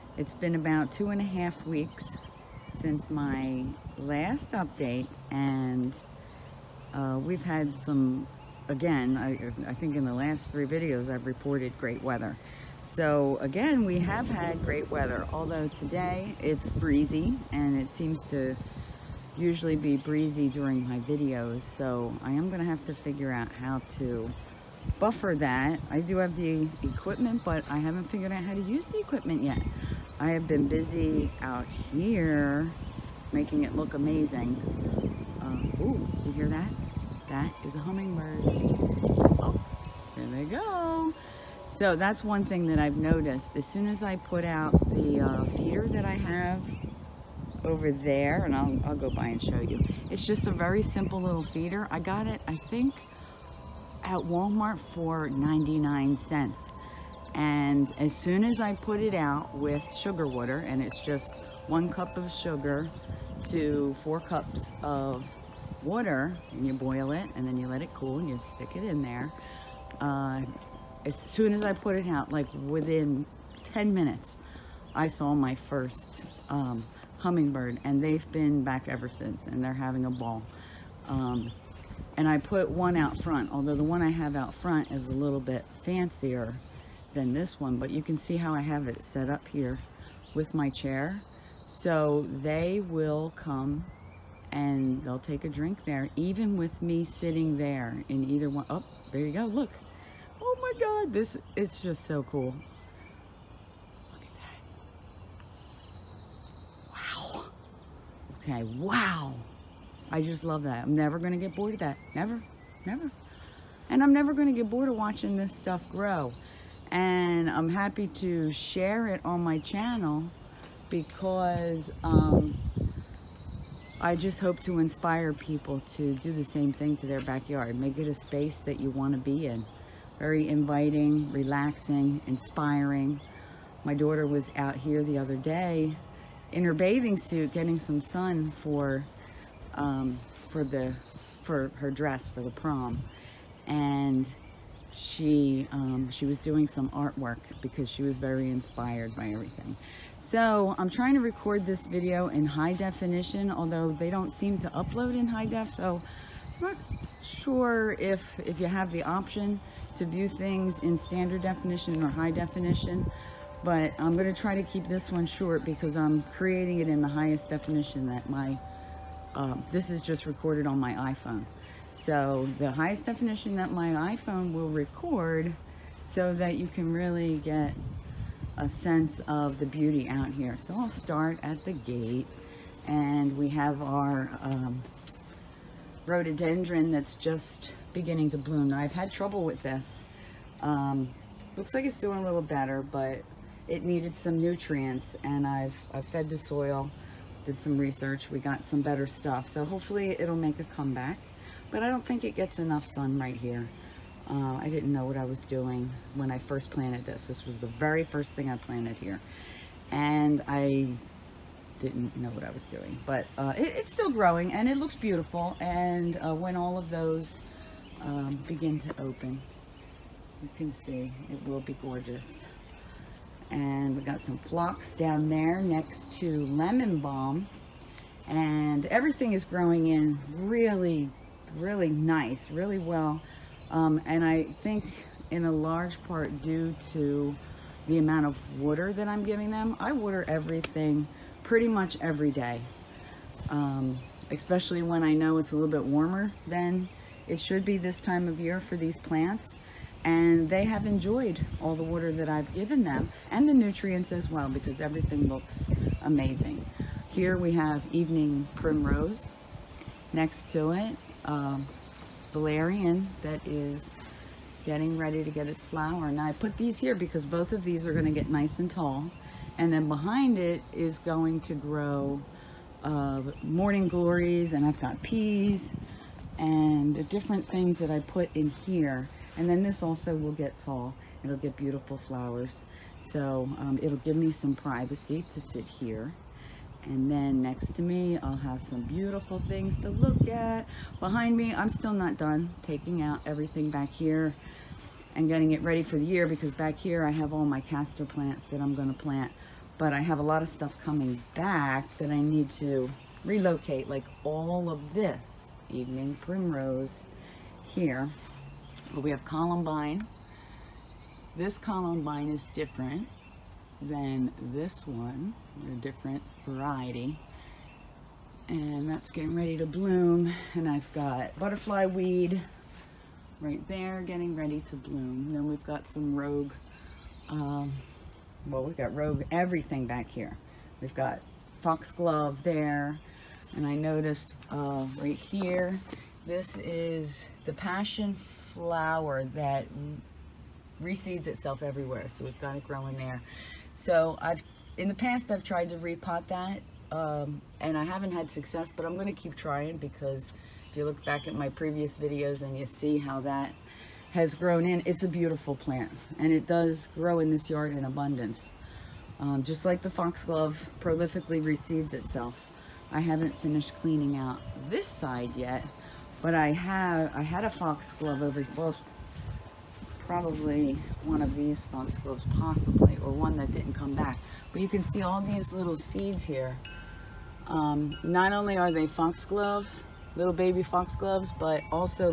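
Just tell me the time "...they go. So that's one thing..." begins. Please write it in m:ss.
0:40.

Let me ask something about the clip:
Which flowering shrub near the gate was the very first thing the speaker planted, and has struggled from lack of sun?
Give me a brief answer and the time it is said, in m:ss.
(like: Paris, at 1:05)
rhododendron, at 3:06.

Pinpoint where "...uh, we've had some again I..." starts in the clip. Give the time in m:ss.
0:06.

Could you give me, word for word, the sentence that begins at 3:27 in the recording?
This was the very first thing I planted here.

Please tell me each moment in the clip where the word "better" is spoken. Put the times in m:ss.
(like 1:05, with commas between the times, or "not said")
3:12, 3:18.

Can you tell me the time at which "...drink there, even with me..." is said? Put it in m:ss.
1:35.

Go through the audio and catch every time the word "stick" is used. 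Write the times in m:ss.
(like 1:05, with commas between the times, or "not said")
1:08.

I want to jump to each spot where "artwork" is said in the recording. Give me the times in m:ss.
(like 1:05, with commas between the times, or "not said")
2:26.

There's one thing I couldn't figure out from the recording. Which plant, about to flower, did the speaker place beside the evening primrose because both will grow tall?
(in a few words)
valerian.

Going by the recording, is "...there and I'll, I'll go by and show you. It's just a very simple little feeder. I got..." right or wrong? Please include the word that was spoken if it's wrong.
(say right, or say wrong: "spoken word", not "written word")
right.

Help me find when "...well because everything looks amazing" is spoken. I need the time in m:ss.
4:14.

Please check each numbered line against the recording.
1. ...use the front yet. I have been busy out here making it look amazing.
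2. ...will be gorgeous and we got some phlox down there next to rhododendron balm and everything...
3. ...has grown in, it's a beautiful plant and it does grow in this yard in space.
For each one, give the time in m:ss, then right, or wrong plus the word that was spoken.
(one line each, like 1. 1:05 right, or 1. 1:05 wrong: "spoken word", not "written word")
1. 0:28 wrong: "equipment", not "front"
2. 3:41 wrong: "lemon", not "rhododendron"
3. 5:54 wrong: "abundance", not "space".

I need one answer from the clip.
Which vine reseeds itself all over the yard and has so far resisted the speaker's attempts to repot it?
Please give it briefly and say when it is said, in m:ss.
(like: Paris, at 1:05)
passion flower, at 5:37.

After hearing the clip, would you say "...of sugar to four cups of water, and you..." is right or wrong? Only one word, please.
right.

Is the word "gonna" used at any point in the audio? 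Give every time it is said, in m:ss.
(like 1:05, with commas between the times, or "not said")
0:22, 2:44, 4:58.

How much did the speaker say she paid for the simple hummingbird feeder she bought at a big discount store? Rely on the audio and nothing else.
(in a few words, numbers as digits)
99 cents.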